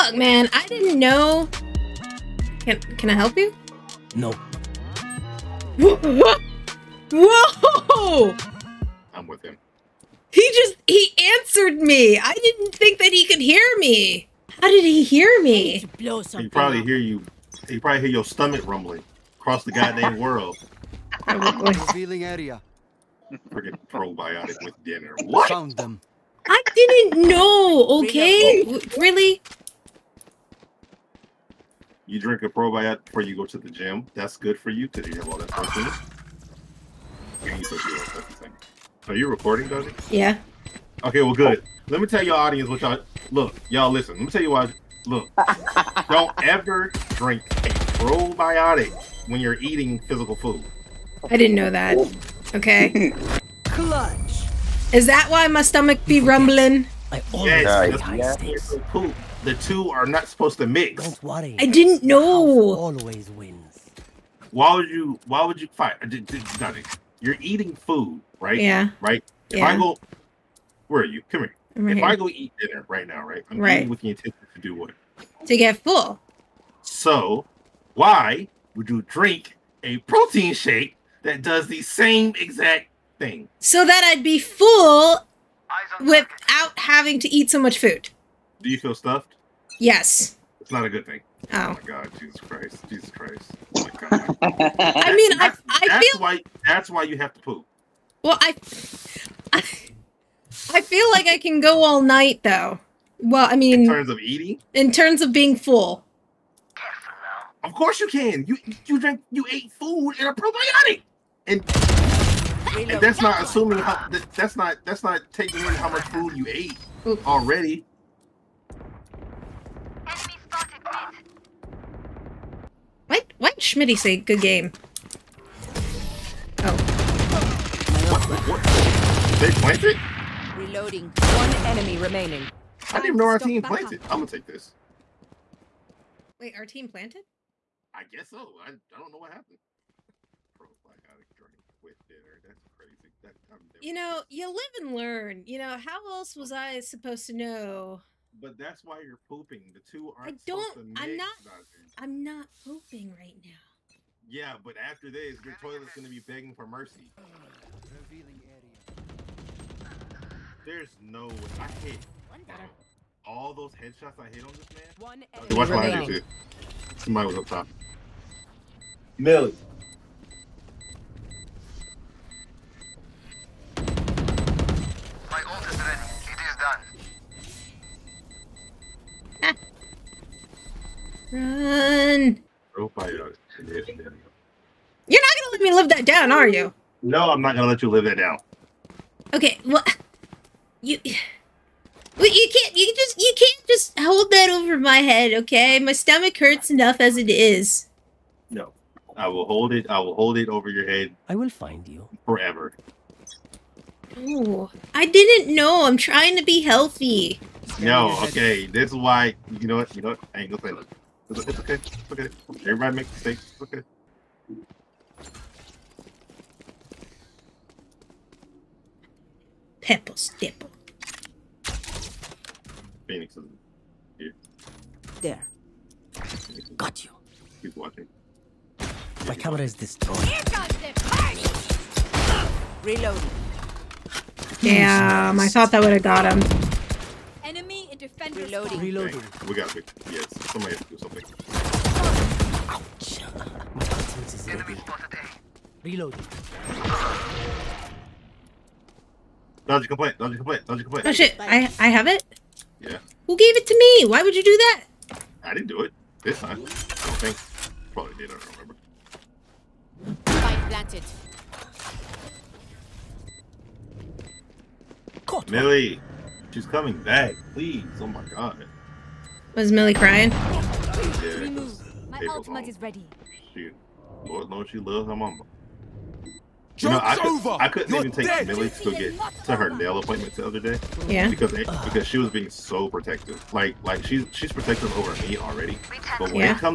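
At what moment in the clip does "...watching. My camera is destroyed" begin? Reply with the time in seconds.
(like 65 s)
227 s.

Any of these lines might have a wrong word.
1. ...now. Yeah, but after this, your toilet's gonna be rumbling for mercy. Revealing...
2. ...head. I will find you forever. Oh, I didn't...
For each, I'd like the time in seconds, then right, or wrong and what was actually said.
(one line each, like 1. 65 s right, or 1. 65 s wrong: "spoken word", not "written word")
1. 153 s wrong: "begging", not "rumbling"
2. 200 s right.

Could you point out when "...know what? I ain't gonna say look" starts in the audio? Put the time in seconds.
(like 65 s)
210 s.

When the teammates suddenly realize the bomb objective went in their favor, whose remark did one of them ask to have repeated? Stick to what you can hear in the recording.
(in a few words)
Schmitty.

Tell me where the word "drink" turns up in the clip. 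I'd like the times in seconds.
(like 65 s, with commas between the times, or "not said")
32 s, 47 s, 79 s, 141 s.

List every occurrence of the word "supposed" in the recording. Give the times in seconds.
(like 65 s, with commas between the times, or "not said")
60 s, 146 s.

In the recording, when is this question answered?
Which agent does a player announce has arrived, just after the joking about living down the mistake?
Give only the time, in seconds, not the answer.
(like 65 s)
223 s.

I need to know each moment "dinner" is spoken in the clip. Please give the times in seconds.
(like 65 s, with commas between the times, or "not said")
24 s, 72 s, 142 s.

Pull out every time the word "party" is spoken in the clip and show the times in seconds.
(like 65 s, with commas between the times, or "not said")
231 s.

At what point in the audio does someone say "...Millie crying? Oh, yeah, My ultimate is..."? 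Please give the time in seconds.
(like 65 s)
269 s.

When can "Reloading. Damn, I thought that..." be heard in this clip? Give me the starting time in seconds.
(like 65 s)
232 s.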